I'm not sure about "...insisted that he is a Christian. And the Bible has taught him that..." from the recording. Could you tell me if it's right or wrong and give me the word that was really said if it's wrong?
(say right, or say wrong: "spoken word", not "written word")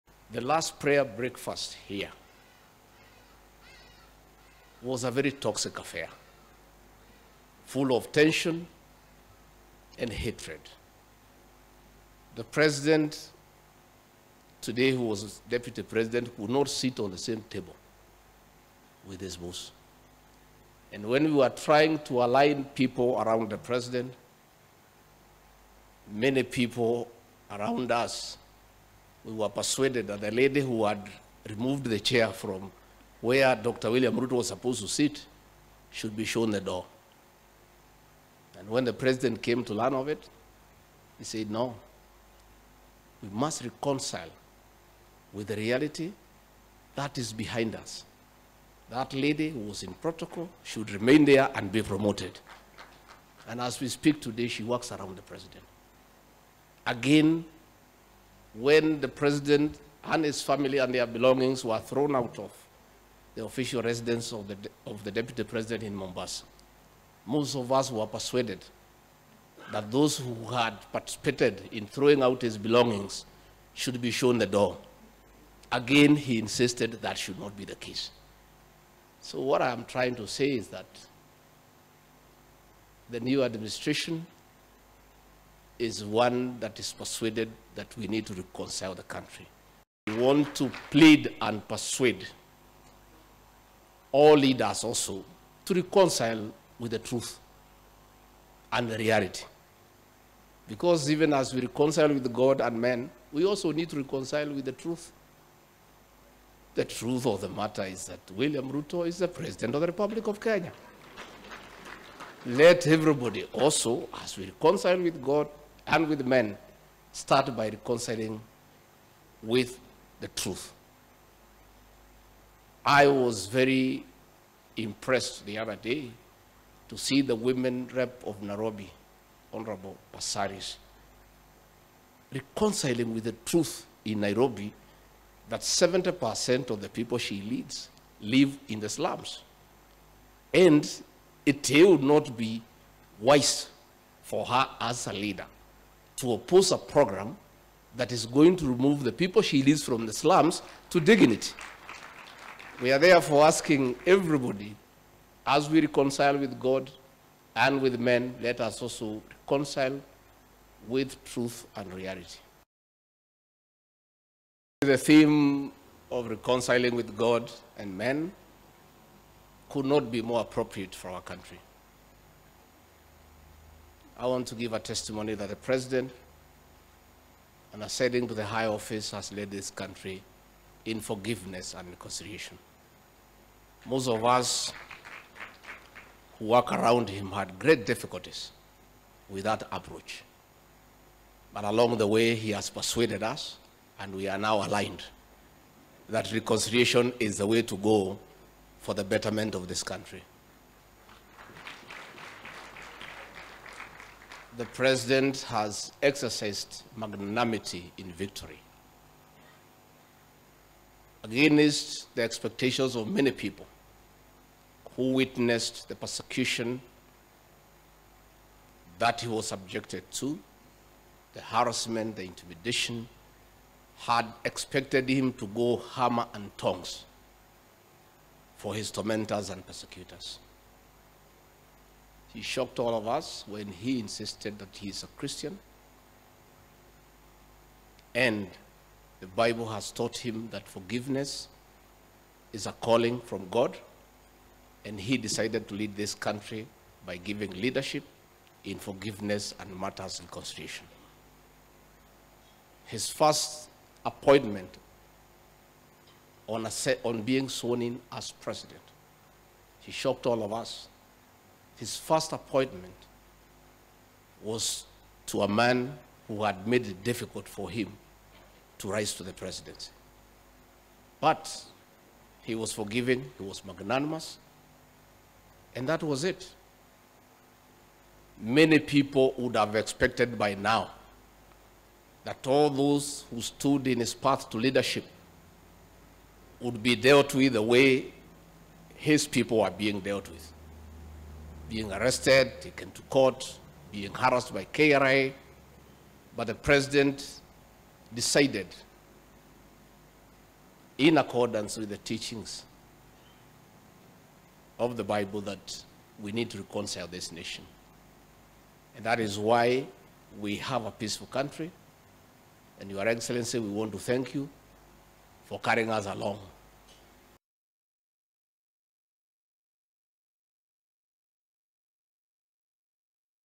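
right.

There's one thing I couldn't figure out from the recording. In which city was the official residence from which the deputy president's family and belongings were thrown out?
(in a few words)
Mombasa.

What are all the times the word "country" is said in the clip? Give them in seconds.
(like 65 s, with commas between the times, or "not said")
89 s, 171 s, 179 s, 199 s, 246 s, 311 s.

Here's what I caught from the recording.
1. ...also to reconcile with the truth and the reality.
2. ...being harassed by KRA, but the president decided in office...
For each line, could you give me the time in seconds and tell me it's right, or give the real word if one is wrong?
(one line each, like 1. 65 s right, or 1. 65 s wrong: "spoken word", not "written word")
1. 94 s right
2. 293 s wrong: "accordance", not "office".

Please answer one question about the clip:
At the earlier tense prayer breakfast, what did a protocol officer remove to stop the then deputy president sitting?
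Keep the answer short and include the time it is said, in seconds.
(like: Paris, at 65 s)
The chair, at 31 s.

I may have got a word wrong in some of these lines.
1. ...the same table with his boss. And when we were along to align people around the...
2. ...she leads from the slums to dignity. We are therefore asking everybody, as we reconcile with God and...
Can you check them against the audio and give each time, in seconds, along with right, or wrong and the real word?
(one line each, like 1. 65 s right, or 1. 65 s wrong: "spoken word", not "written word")
1. 17 s wrong: "trying", not "along"
2. 149 s right.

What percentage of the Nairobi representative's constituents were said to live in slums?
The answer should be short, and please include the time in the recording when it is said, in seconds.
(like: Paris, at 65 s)
70%, at 135 s.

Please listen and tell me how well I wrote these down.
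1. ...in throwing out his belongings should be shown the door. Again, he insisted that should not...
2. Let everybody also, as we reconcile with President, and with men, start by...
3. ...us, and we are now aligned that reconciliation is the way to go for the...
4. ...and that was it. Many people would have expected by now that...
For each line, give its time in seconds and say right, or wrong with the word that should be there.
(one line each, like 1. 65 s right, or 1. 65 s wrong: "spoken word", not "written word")
1. 71 s right
2. 112 s wrong: "God", not "President"
3. 193 s right
4. 275 s right.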